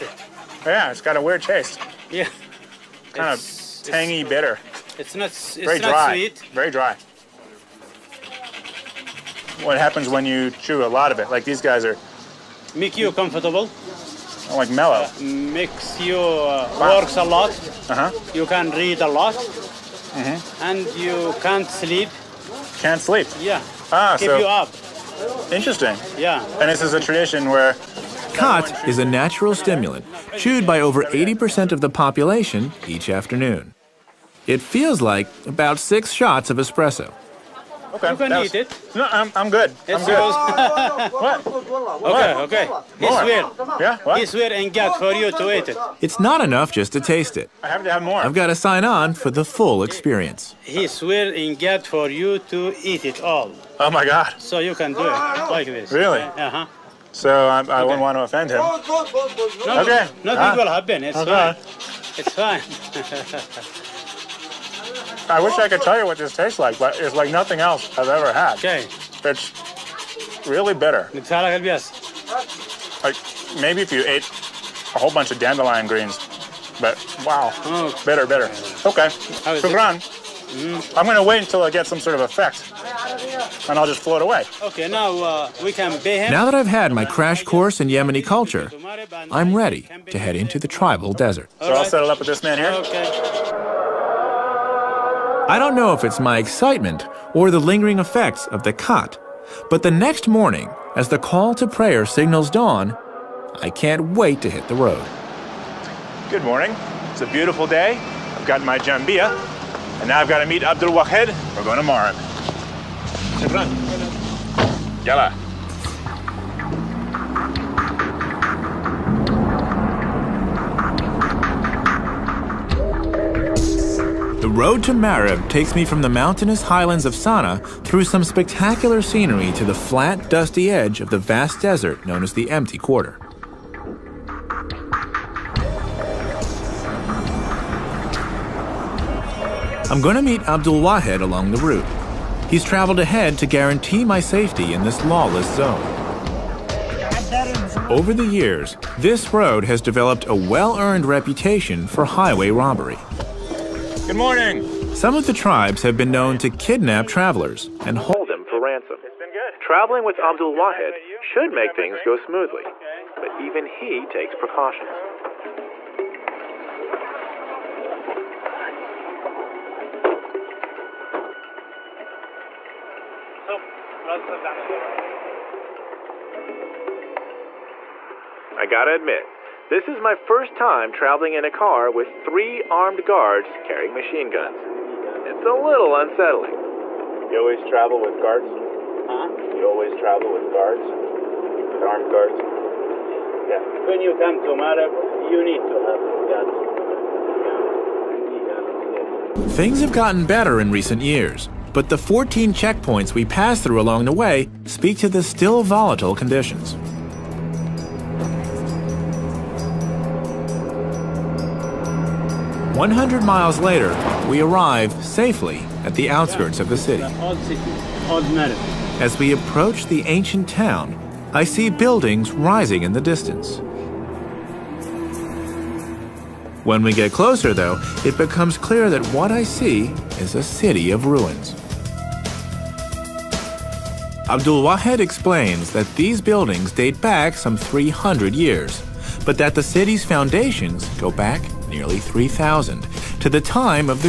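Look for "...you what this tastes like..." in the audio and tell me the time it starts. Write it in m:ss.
1:05.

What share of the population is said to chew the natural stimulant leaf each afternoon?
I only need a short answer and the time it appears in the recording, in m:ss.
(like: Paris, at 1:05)
over 80%, at 0:30.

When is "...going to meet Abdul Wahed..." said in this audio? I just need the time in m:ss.
2:20.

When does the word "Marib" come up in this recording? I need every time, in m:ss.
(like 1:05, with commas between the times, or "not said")
2:04, 3:14.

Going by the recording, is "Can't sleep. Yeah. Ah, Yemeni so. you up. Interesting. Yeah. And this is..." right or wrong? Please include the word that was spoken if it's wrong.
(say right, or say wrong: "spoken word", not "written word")
wrong: "Keep", not "Yemeni".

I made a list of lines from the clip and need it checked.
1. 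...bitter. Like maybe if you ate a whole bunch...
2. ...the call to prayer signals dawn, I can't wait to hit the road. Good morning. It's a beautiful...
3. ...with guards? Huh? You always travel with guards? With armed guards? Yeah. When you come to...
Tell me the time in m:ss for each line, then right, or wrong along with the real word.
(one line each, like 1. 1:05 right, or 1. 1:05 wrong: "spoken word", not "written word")
1. 1:10 right
2. 1:41 right
3. 3:07 right.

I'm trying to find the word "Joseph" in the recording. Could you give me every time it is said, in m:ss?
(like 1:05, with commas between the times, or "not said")
not said.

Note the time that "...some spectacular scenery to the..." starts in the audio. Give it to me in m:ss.
2:08.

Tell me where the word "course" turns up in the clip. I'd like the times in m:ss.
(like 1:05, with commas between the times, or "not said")
1:27.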